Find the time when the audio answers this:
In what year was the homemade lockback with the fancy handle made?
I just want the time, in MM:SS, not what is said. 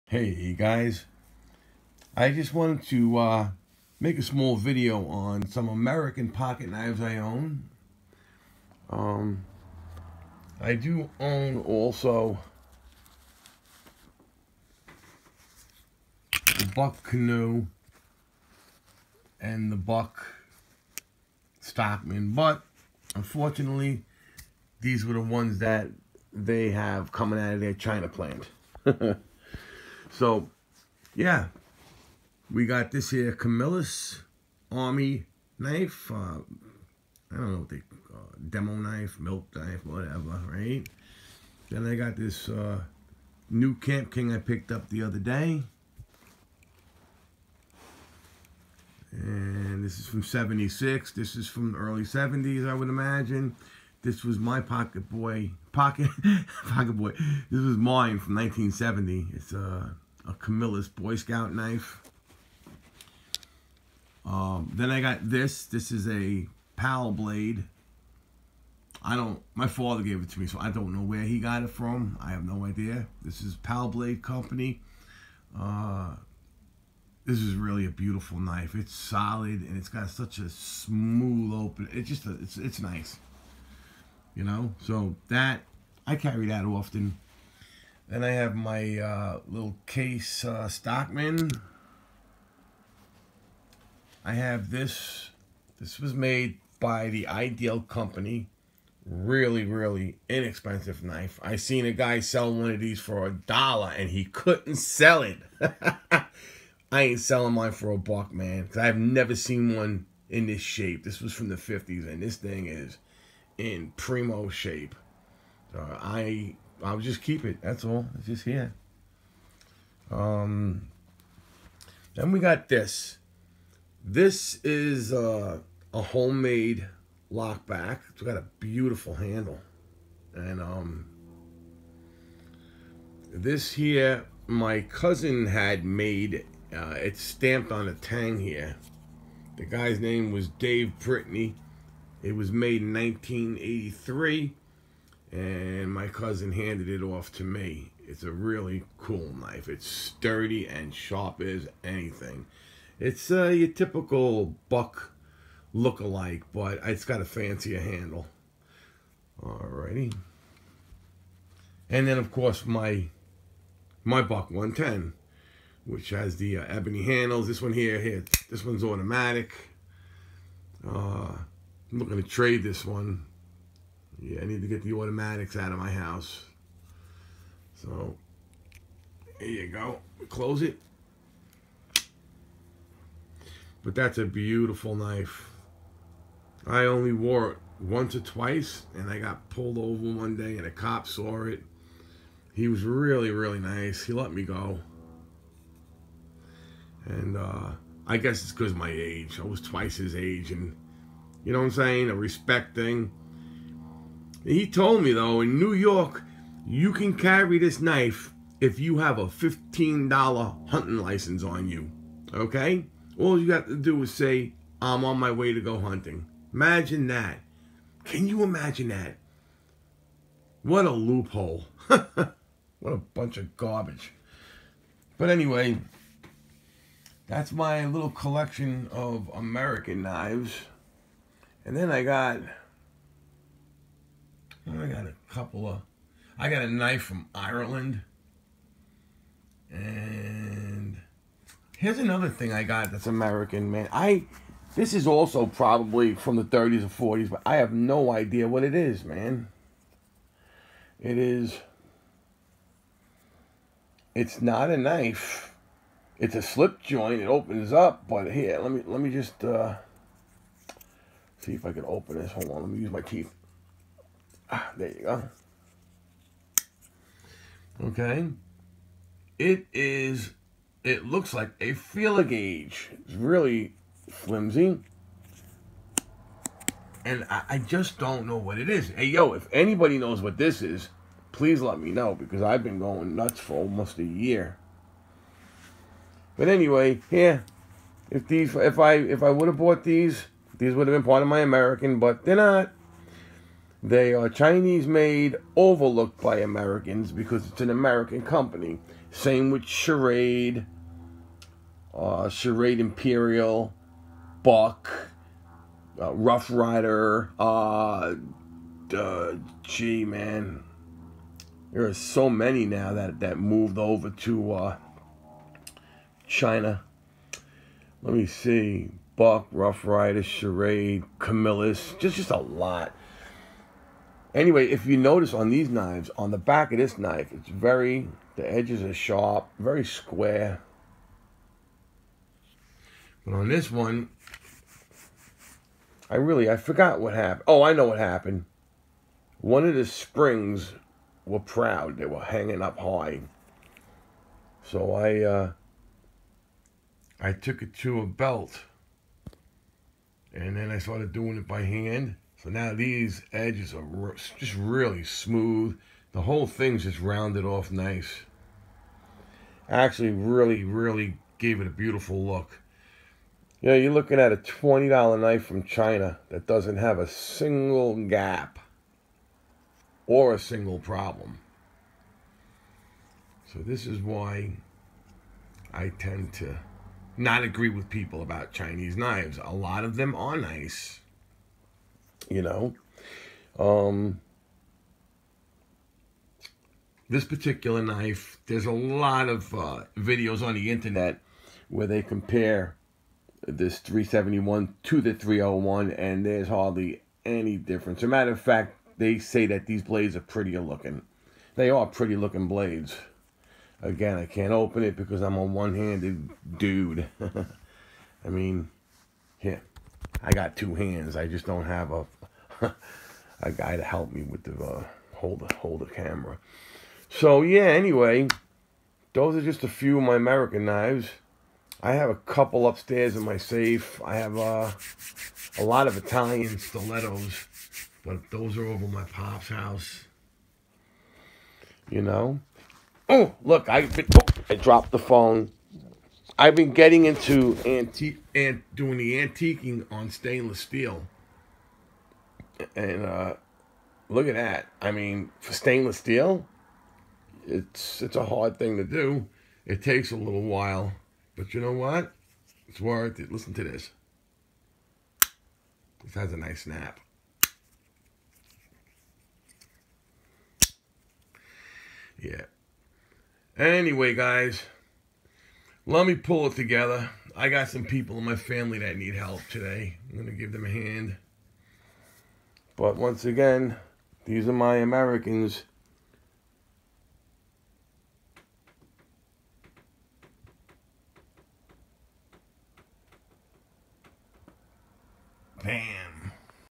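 02:22.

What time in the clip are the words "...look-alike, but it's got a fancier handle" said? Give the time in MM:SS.
02:35.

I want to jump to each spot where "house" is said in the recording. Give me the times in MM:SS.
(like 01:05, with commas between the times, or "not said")
02:55, 07:09.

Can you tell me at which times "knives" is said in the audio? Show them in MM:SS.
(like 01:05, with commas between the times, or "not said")
00:06, 03:50, 05:25, 06:18, 07:00.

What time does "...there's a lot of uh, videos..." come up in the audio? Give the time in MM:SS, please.
06:28.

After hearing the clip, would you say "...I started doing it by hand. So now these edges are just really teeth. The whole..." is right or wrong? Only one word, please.
wrong.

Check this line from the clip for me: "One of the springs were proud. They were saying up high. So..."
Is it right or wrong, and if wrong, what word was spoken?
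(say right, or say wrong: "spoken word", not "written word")
wrong: "hanging", not "saying".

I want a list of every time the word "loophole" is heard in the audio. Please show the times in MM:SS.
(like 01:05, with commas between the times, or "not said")
03:40.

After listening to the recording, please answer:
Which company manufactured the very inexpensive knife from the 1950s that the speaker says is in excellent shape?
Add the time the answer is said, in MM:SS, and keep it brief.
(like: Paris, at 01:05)
Ideal Company, at 01:37.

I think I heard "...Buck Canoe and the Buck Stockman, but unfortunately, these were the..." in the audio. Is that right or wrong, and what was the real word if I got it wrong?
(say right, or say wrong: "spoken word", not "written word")
right.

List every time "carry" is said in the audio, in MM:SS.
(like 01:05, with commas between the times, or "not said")
01:26, 03:27.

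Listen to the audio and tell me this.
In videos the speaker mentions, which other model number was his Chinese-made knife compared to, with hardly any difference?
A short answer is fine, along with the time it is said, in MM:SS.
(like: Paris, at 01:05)
301, at 06:35.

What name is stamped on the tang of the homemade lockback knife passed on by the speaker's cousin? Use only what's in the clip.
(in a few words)
Dave Brittany.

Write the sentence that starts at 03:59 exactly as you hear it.
And here's another thing I got that's American, man.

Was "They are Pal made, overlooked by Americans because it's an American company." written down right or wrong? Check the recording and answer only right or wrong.
wrong.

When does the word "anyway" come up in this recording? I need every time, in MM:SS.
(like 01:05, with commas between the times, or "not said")
03:45, 04:46, 05:24, 06:57, 07:43.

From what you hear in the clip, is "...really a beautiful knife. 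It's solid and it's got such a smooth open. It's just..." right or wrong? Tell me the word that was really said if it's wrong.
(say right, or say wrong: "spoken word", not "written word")
right.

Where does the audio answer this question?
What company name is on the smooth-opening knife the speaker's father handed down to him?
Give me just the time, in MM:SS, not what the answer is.
01:13.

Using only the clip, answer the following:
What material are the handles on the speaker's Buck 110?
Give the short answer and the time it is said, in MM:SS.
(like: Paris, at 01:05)
Ebony, at 02:46.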